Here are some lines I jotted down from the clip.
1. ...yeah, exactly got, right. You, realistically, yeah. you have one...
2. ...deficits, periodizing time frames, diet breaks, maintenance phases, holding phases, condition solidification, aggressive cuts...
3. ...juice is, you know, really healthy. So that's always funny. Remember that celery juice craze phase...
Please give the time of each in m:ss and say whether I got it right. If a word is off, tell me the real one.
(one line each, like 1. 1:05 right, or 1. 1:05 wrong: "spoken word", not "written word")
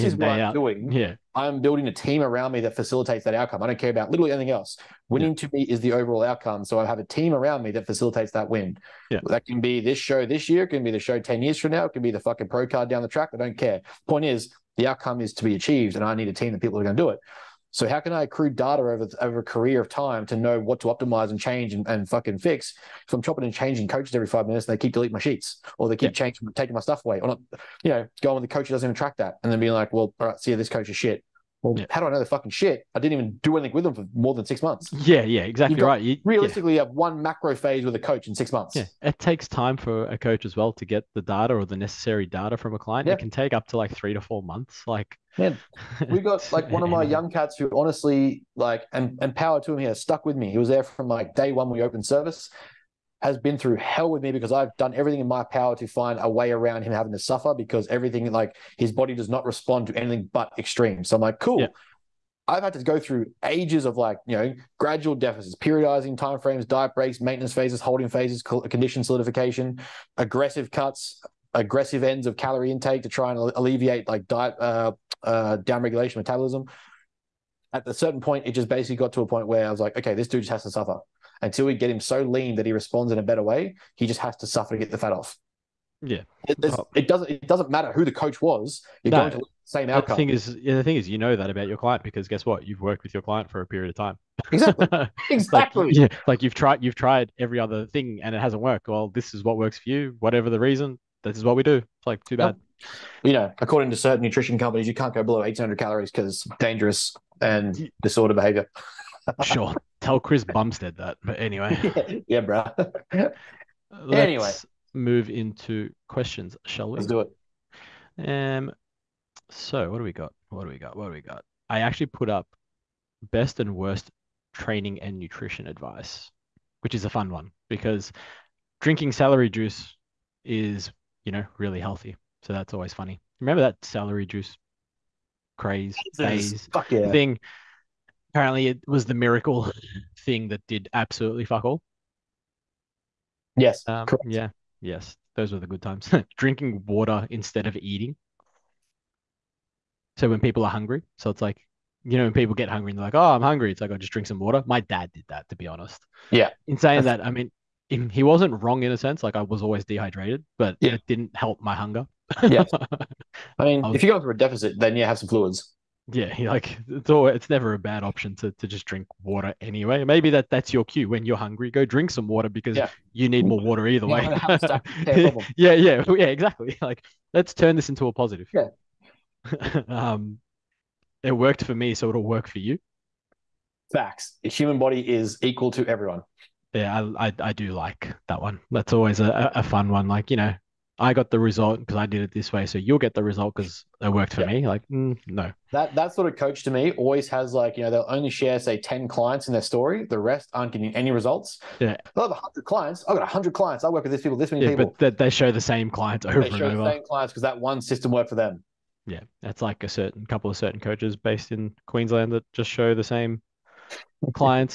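1. 0:35 right
2. 1:05 right
3. 2:09 right.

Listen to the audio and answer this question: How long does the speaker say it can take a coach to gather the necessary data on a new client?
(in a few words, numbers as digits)
3 to 4 months.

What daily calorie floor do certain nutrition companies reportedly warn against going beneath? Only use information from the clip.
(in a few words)
800 calories.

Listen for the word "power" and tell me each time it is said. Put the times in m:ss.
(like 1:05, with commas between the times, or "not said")
0:49, 0:55.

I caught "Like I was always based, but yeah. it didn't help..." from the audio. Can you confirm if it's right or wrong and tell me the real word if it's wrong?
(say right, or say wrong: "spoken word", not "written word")
wrong: "dehydrated", not "based".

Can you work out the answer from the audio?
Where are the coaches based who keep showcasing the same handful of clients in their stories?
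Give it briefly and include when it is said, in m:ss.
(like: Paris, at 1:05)
Queensland, at 3:31.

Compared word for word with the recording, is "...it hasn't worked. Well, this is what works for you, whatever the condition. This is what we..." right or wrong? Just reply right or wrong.
wrong.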